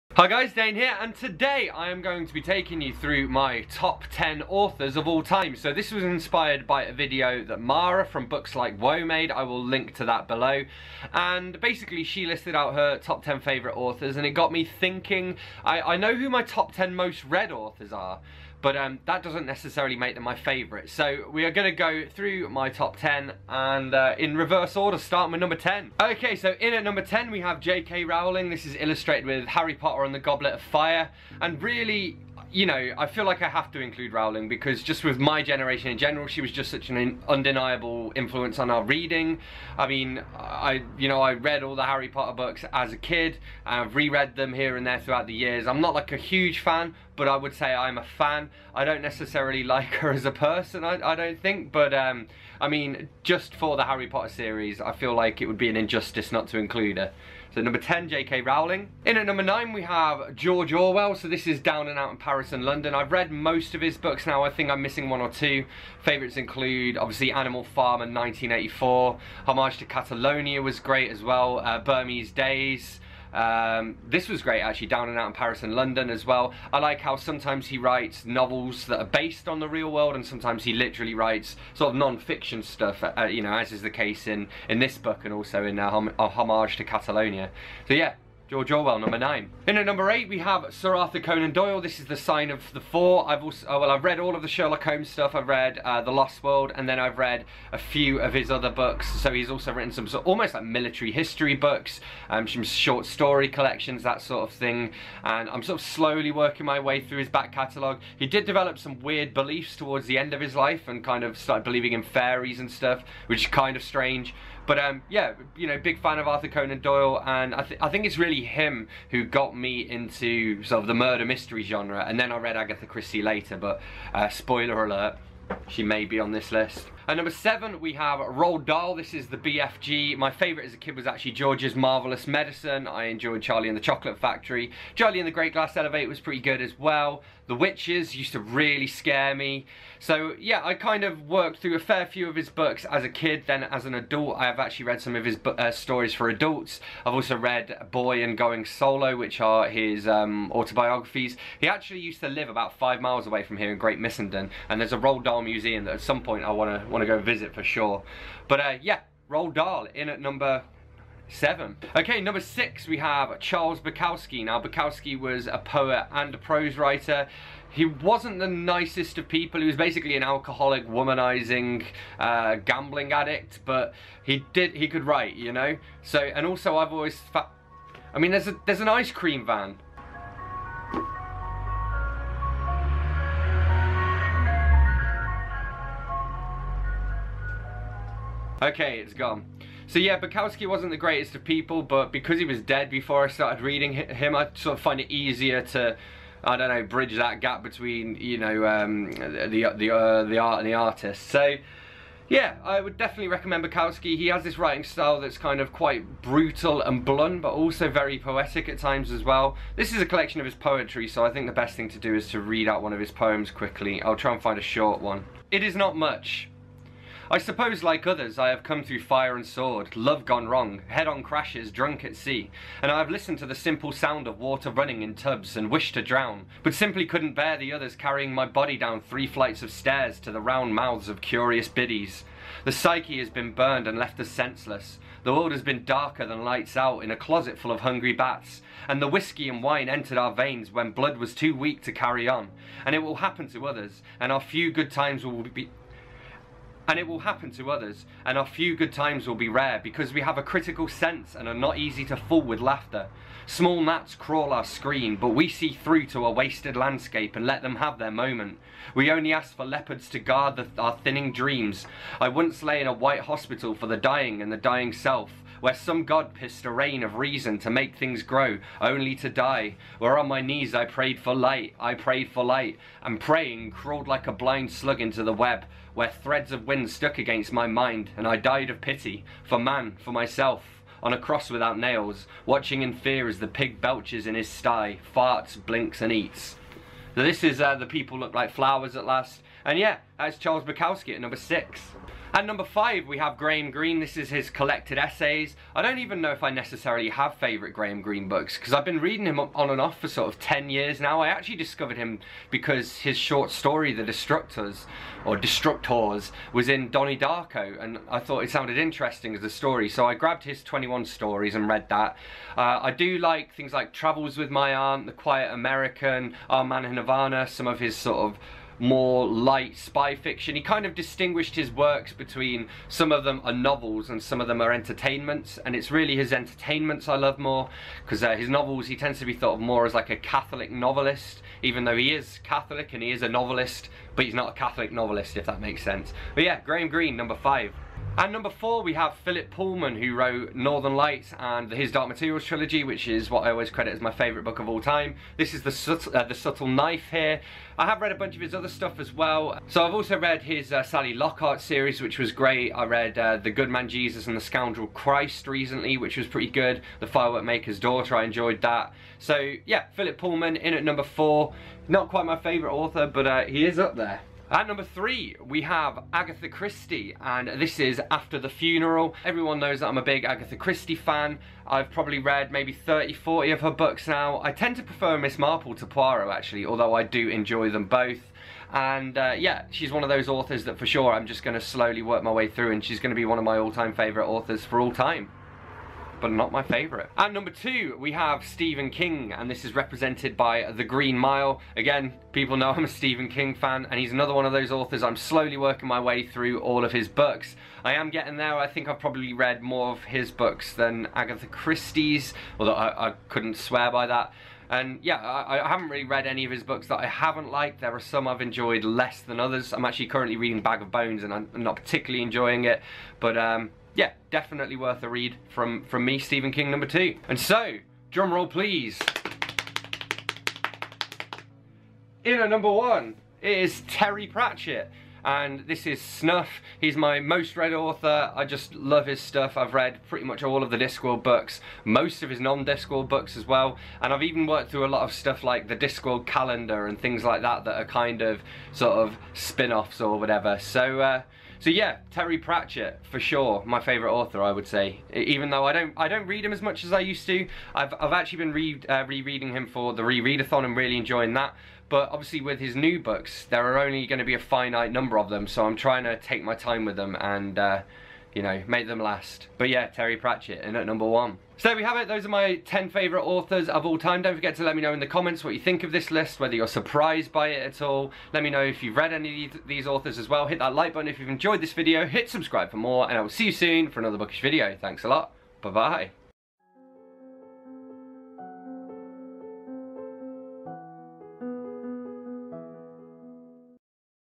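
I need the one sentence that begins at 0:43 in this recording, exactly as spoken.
I've reread them here and there throughout the years.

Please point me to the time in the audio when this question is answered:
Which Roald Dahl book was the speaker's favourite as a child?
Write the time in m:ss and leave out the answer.
2:11.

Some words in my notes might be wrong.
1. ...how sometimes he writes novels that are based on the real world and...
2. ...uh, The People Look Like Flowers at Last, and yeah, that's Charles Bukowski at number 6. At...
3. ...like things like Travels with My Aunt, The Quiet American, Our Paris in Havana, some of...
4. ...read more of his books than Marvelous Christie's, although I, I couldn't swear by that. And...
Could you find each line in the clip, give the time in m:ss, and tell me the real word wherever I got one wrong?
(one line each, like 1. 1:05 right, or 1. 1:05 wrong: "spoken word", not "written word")
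1. 1:17 right
2. 4:47 right
3. 5:13 wrong: "Man", not "Paris"
4. 6:39 wrong: "Agatha", not "Marvelous".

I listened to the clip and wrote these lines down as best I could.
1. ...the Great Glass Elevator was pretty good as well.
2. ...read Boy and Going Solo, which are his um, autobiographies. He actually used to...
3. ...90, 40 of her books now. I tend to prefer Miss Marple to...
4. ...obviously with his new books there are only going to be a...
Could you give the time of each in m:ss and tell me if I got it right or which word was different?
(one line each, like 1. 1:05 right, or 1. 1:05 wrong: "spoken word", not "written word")
1. 2:15 right
2. 2:27 right
3. 6:12 wrong: "30", not "90"
4. 7:32 right.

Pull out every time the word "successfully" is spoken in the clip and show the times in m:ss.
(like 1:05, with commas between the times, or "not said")
not said.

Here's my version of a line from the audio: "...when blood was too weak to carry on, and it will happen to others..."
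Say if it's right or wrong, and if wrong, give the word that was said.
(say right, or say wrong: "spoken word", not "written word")
right.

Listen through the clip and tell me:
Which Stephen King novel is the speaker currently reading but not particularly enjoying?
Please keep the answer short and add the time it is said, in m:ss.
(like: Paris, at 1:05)
Bag of Bones, at 6:50.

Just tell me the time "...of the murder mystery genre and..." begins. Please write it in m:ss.
2:00.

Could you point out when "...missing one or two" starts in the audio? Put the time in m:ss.
1:04.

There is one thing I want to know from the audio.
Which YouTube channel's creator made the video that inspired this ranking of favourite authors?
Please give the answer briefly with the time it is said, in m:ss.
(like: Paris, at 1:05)
Books Like Woah, at 0:08.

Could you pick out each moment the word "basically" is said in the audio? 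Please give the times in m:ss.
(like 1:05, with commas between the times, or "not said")
0:11, 2:49.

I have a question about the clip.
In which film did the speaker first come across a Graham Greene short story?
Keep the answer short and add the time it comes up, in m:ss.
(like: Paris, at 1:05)
Donnie Darko, at 5:06.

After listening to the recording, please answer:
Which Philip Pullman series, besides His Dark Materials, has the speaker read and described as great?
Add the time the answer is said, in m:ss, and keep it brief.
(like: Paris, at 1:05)
Sally Lockhart, at 5:50.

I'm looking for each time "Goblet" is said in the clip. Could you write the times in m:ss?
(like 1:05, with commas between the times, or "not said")
0:30.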